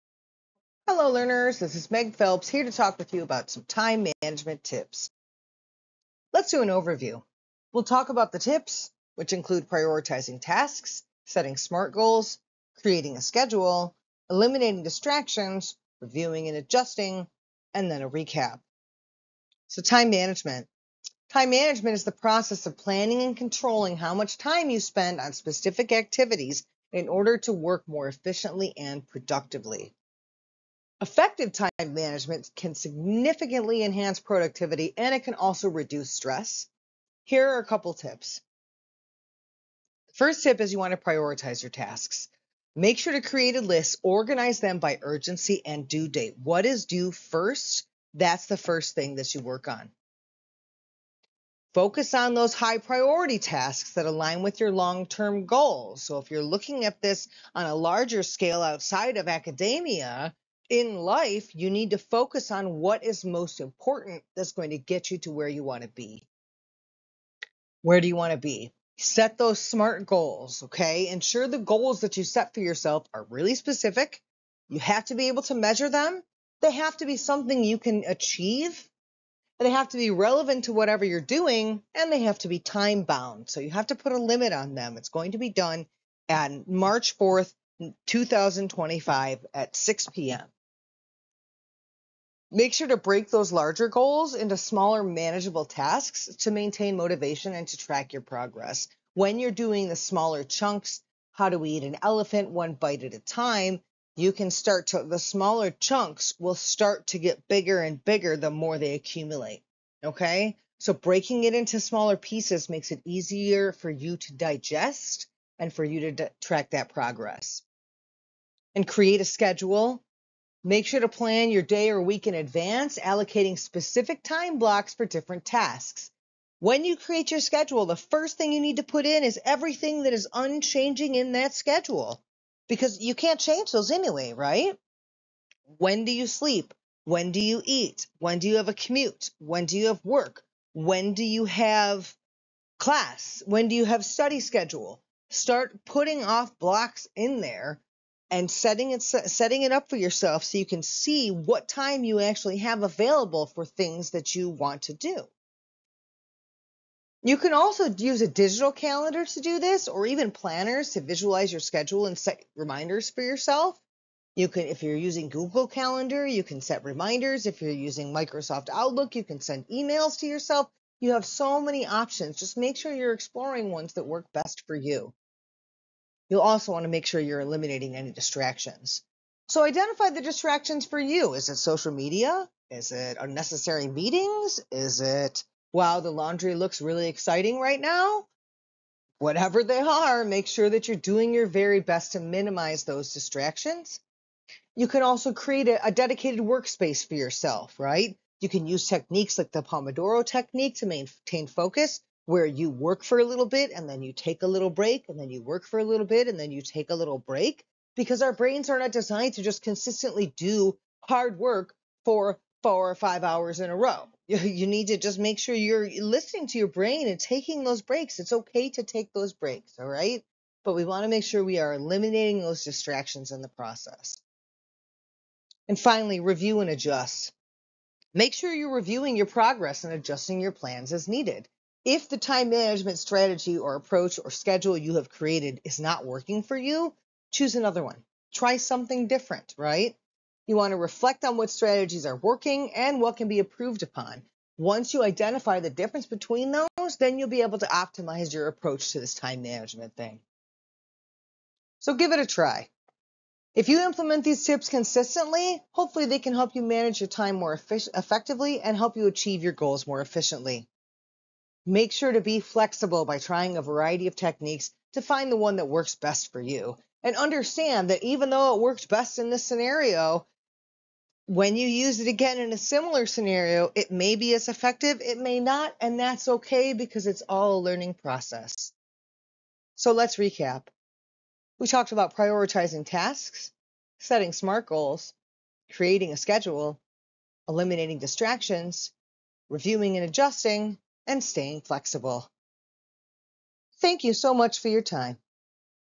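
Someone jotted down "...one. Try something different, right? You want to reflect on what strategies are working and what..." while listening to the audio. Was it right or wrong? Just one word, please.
right.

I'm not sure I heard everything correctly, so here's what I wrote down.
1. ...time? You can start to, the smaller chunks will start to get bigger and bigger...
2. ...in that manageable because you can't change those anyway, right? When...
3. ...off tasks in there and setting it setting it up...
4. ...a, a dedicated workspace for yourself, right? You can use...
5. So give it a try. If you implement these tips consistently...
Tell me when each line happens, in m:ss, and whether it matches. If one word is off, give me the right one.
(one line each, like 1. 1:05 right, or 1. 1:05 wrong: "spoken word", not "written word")
1. 1:43 right
2. 2:11 wrong: "schedule", not "manageable"
3. 2:26 wrong: "blocks", not "tasks"
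4. 3:15 right
5. 4:11 right.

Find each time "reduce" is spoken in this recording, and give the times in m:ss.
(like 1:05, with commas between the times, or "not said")
0:35.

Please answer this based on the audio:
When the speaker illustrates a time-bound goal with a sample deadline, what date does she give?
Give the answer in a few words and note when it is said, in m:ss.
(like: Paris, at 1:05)
March 4, 2025, at 1:26.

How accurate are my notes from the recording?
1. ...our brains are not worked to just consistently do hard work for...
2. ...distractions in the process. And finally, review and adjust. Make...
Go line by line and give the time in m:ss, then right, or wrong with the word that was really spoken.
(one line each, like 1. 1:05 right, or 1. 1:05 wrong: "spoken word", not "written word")
1. 3:28 wrong: "designed", not "worked"
2. 3:42 right.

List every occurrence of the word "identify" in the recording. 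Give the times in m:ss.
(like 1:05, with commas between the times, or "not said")
2:59, 4:05.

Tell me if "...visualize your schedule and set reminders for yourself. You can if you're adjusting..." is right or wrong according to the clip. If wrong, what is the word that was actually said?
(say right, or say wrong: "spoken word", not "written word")
wrong: "using", not "adjusting".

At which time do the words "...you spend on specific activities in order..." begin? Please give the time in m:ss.
0:24.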